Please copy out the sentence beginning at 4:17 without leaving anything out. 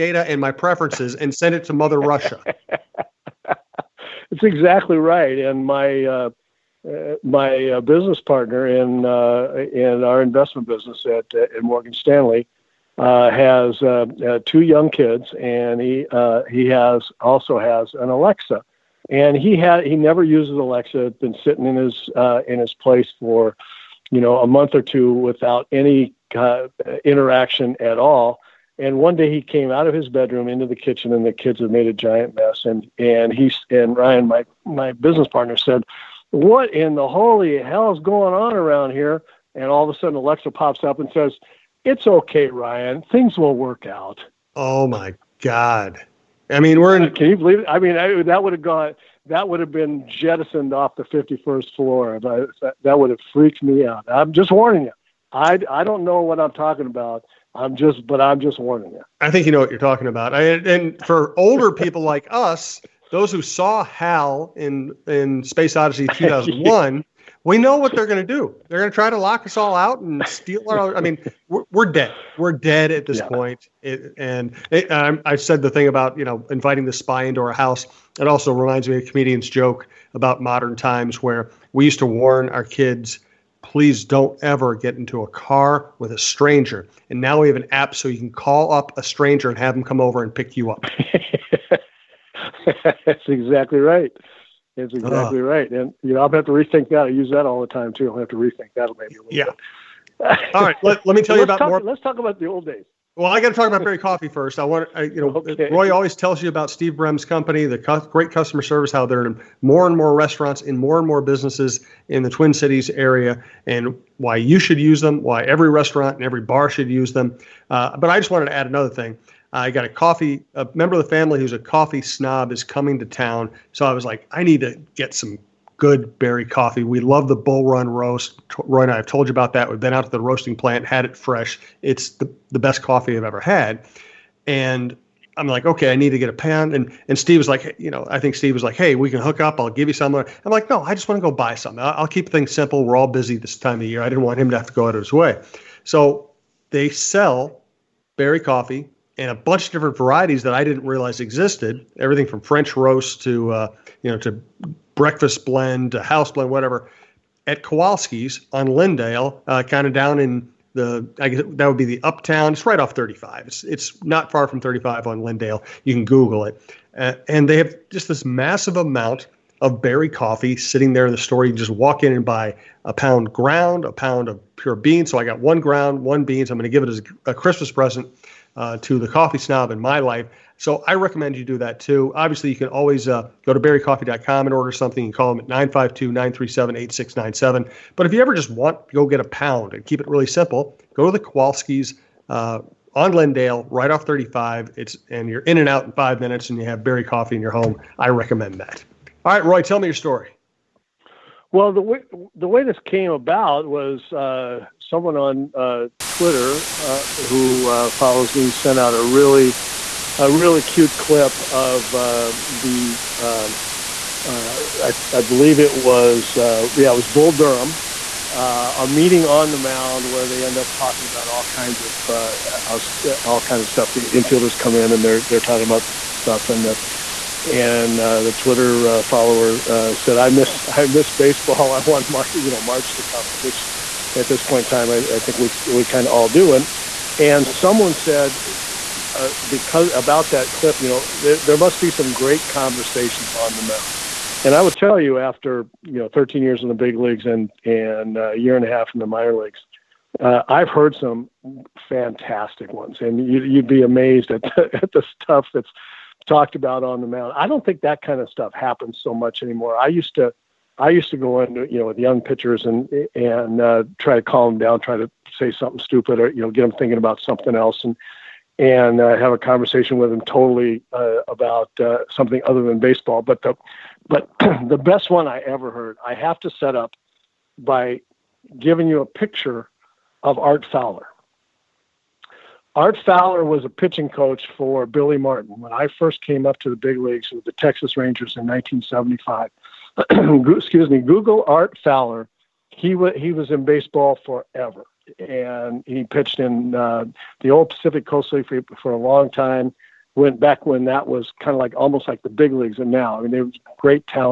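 I don't think that kind of stuff happens so much anymore.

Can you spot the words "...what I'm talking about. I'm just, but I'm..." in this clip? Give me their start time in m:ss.
0:56.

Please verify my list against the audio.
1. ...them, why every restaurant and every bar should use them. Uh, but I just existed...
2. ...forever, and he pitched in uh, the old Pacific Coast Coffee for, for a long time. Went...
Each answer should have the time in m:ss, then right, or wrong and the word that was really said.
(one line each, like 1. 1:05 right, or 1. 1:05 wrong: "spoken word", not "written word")
1. 1:55 wrong: "wanted", not "existed"
2. 4:54 wrong: "League", not "Coffee".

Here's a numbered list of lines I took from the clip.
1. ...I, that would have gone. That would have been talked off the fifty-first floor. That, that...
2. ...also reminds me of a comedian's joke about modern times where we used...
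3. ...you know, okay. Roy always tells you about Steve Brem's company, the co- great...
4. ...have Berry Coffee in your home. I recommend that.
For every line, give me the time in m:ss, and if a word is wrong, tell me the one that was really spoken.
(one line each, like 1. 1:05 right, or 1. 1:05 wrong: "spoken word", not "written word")
1. 0:47 wrong: "jettisoned", not "talked"
2. 1:18 right
3. 1:45 right
4. 3:16 right.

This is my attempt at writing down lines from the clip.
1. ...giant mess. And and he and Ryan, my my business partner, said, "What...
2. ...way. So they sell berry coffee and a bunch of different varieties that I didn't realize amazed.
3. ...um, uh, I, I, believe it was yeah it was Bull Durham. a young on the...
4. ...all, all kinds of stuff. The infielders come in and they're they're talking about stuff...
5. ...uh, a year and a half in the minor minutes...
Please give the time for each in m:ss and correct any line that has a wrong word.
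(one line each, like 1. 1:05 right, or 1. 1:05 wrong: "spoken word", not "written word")
1. 0:31 right
2. 2:25 wrong: "existed", not "amazed"
3. 3:33 wrong: "meeting", not "young"
4. 3:42 right
5. 4:08 wrong: "leagues", not "minutes".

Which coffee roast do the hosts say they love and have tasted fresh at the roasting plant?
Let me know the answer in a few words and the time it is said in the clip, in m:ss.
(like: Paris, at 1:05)
Bull Run, at 2:07.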